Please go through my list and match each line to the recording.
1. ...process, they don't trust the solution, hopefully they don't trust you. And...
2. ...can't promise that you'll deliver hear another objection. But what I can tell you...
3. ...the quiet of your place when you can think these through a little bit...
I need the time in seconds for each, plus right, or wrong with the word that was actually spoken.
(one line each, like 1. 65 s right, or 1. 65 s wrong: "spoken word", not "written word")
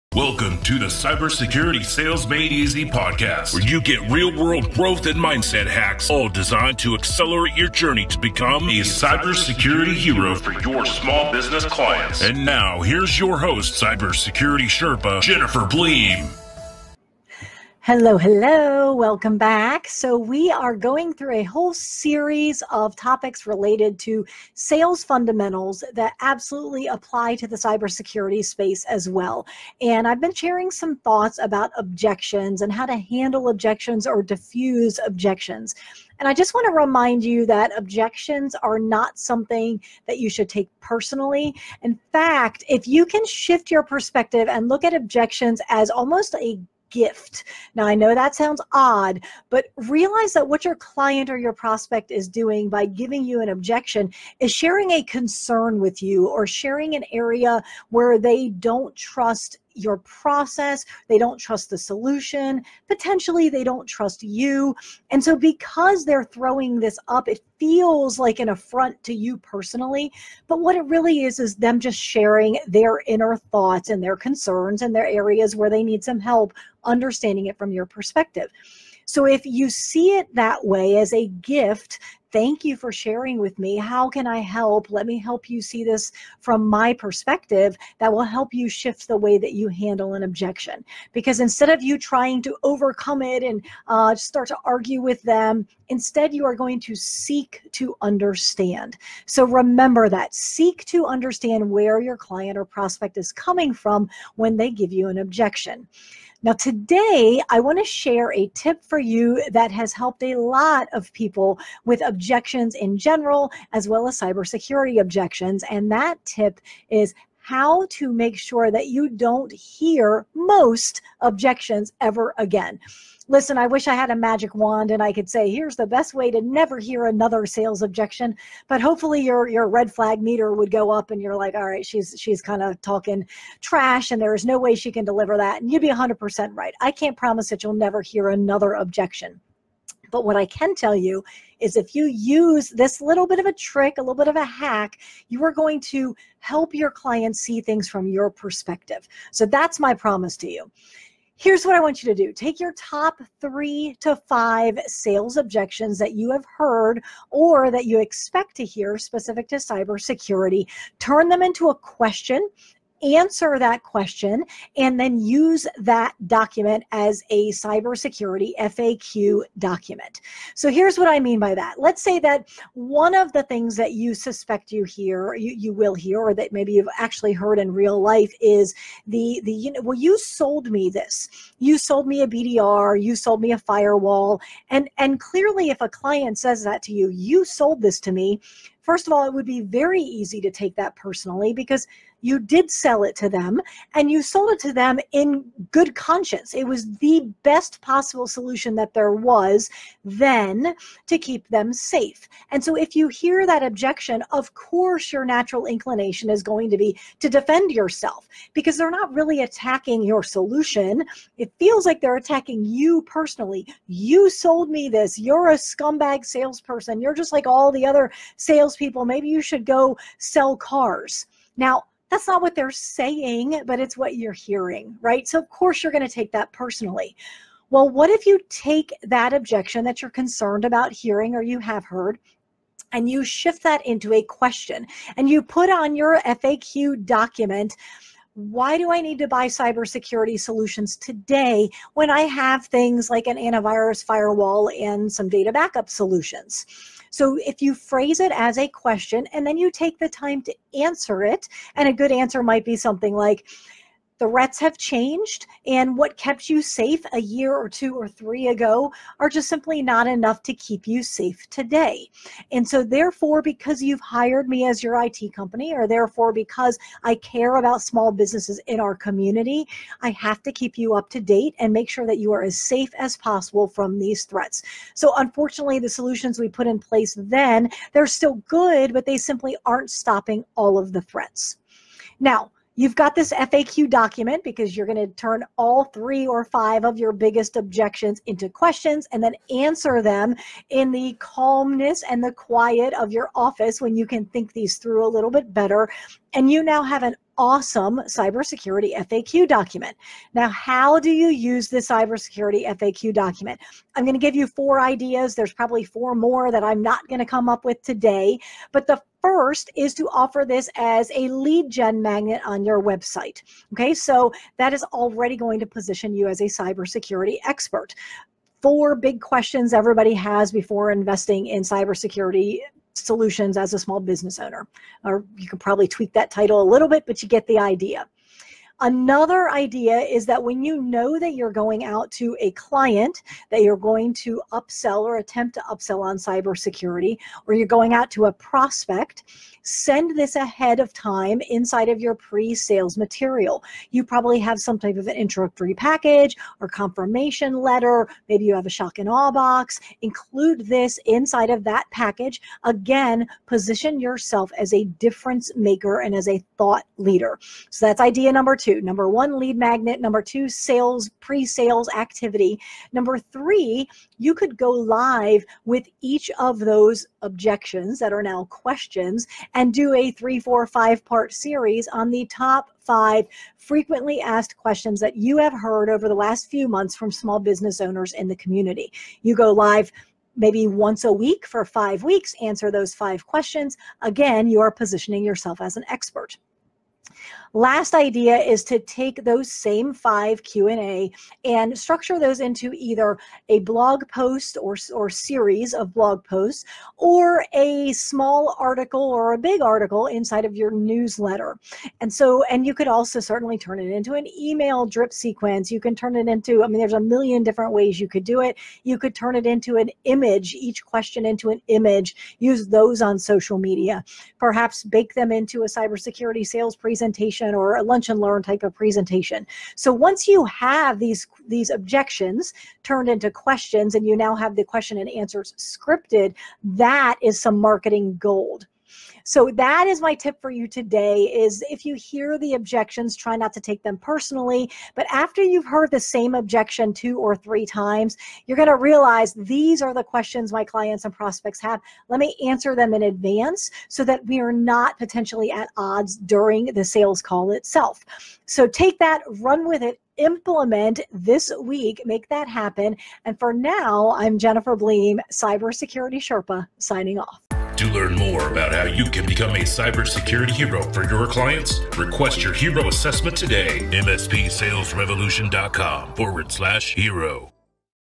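1. 59 s wrong: "potentially", not "hopefully"
2. 136 s wrong: "never", not "deliver"
3. 292 s wrong: "office", not "place".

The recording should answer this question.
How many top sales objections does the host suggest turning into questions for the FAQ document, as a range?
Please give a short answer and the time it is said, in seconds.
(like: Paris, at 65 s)
3 to 5, at 153 s.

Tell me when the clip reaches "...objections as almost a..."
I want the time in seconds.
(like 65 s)
44 s.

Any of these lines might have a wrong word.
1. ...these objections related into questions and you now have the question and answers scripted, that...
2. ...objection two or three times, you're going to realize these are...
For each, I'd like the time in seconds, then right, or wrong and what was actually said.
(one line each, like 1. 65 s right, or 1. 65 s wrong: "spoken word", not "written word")
1. 421 s wrong: "turned", not "related"
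2. 436 s right.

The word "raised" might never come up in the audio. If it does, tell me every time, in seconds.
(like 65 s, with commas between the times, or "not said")
not said.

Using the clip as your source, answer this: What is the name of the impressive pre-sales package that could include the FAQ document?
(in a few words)
shock and awe box.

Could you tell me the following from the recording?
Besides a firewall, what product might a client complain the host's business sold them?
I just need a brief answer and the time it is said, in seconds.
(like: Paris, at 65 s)
BDR, at 182 s.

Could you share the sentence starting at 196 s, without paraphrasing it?
It was the best possible solution that there was then to keep them safe.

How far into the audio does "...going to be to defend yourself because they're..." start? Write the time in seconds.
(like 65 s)
206 s.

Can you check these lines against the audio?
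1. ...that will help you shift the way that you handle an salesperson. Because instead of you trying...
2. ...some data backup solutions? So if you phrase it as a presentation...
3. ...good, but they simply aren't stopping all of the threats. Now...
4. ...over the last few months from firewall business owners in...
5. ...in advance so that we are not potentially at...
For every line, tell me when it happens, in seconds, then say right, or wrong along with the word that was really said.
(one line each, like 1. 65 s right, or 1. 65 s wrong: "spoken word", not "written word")
1. 87 s wrong: "objection", not "salesperson"
2. 245 s wrong: "question", not "presentation"
3. 278 s right
4. 375 s wrong: "small", not "firewall"
5. 442 s right.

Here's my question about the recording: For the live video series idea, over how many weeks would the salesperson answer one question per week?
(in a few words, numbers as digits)
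5.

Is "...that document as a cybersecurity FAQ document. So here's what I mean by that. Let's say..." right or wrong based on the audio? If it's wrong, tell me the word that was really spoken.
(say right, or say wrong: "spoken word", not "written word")
right.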